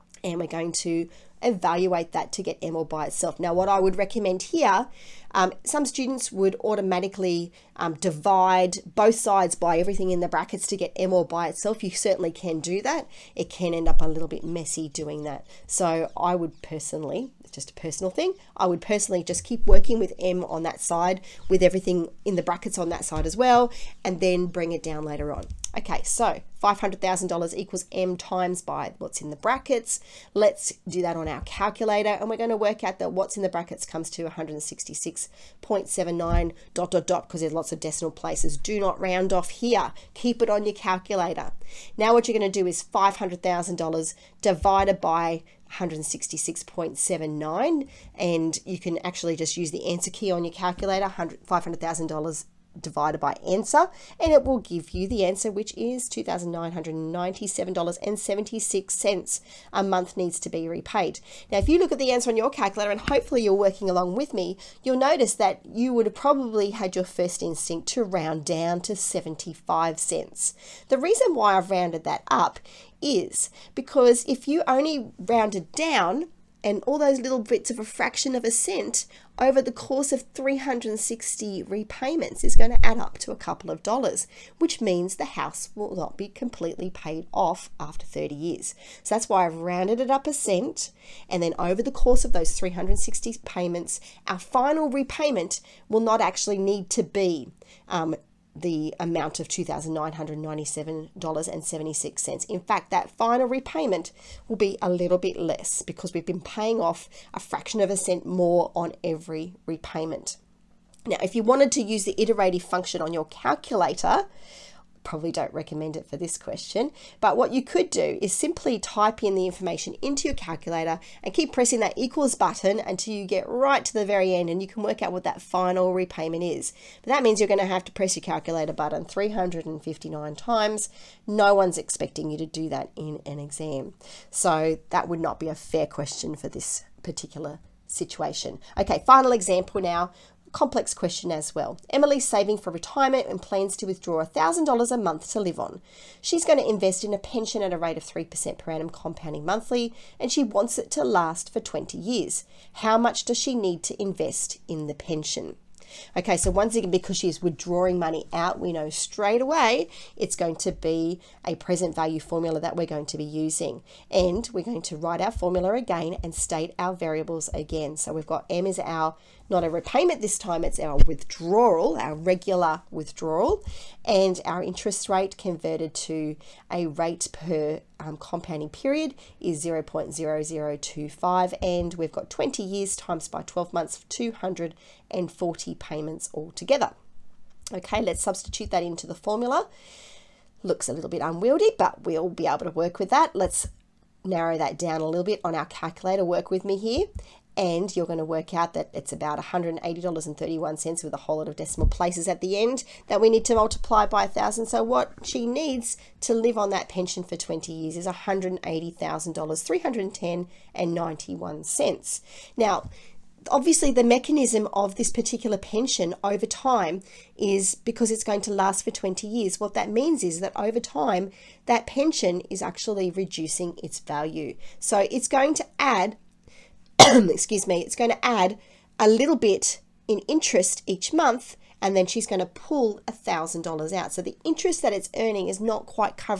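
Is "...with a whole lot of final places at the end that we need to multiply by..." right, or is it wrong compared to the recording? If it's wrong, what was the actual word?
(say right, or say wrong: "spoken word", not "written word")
wrong: "decimal", not "final".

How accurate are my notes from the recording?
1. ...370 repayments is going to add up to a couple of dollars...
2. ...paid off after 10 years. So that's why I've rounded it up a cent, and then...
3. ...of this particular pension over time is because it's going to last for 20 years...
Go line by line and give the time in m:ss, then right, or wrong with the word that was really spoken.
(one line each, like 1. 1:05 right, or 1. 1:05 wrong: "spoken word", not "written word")
1. 1:20 wrong: "360", not "370"
2. 1:26 wrong: "30", not "10"
3. 3:34 right.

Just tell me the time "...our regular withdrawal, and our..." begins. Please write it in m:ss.
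2:51.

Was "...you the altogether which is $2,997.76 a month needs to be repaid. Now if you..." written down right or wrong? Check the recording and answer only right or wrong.
wrong.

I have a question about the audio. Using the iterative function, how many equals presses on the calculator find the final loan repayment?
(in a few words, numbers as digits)
359.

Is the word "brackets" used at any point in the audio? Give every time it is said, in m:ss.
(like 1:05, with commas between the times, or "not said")
0:10, 0:22, 0:29, 0:33.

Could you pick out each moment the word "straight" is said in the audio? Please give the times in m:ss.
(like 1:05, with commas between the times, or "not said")
2:38.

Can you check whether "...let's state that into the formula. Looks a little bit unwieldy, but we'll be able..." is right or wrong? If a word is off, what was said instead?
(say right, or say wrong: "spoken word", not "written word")
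wrong: "substitute", not "state".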